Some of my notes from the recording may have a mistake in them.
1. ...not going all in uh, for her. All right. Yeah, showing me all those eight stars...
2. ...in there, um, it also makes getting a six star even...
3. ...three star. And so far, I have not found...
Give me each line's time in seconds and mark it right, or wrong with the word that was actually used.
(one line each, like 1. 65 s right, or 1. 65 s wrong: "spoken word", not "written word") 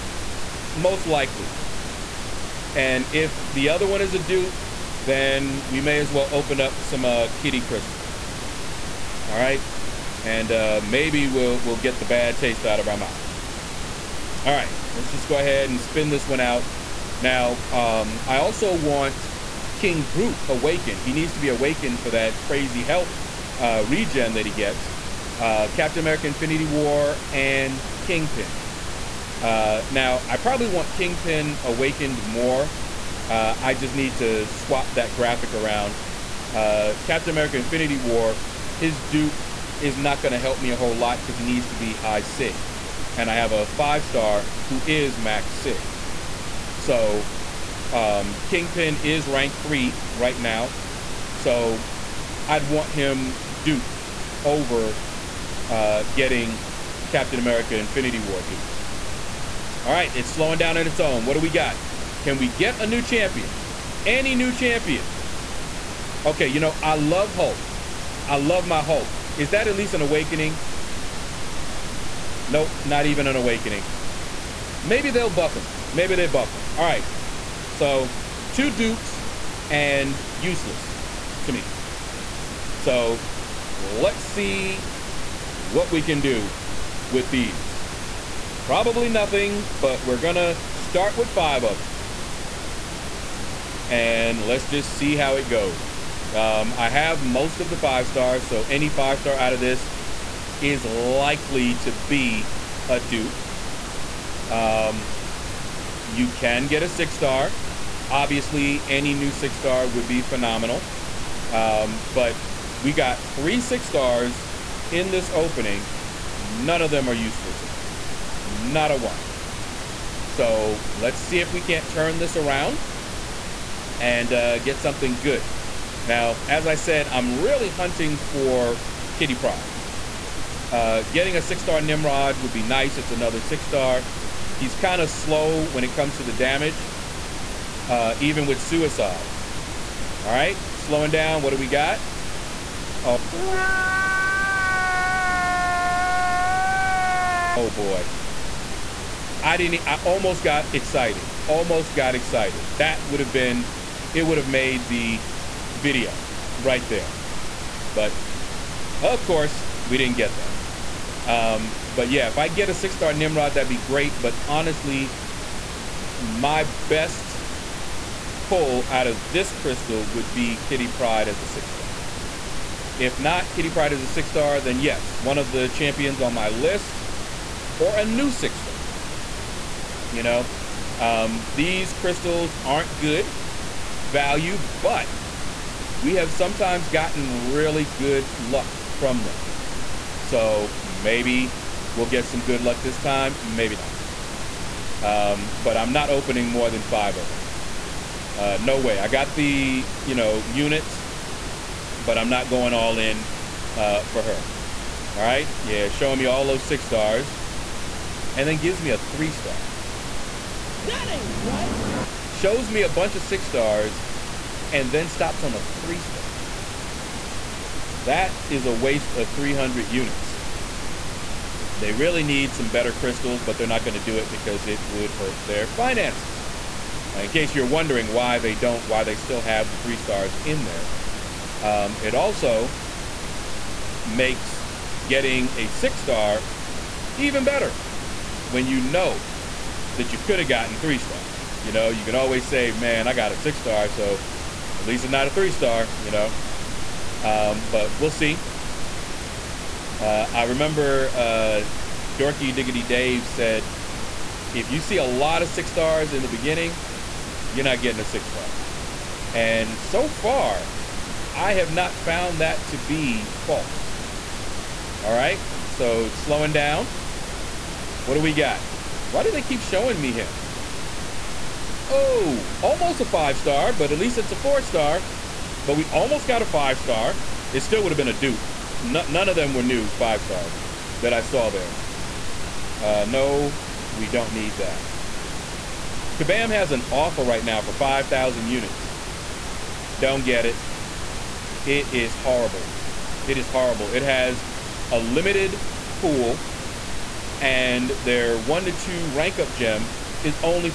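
1. 202 s wrong: "six", not "eight"
2. 230 s right
3. 258 s wrong: "six", not "three".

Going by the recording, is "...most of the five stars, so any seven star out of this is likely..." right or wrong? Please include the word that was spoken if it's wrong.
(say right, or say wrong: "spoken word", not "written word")
wrong: "five", not "seven".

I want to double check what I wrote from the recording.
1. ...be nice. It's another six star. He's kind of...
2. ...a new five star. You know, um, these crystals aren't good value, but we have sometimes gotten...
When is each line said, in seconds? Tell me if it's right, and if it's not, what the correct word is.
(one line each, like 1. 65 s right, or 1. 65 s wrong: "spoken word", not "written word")
1. 132 s right
2. 177 s wrong: "six", not "five".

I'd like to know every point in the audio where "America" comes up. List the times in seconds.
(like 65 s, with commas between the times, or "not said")
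26 s, 37 s, 57 s.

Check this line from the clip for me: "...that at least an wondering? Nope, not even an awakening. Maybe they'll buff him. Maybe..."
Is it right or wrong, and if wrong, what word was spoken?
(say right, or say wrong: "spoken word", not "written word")
wrong: "awakening", not "wondering".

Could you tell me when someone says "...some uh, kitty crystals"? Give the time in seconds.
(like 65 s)
6 s.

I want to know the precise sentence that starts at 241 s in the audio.
You know, you can always say, man, I got a six star, so at least it's not a three star, you know.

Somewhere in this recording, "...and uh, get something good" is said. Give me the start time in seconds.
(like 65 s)
123 s.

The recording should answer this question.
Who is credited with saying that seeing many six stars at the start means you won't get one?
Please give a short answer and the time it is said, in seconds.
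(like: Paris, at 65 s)
Dorky Diggity Dave, at 252 s.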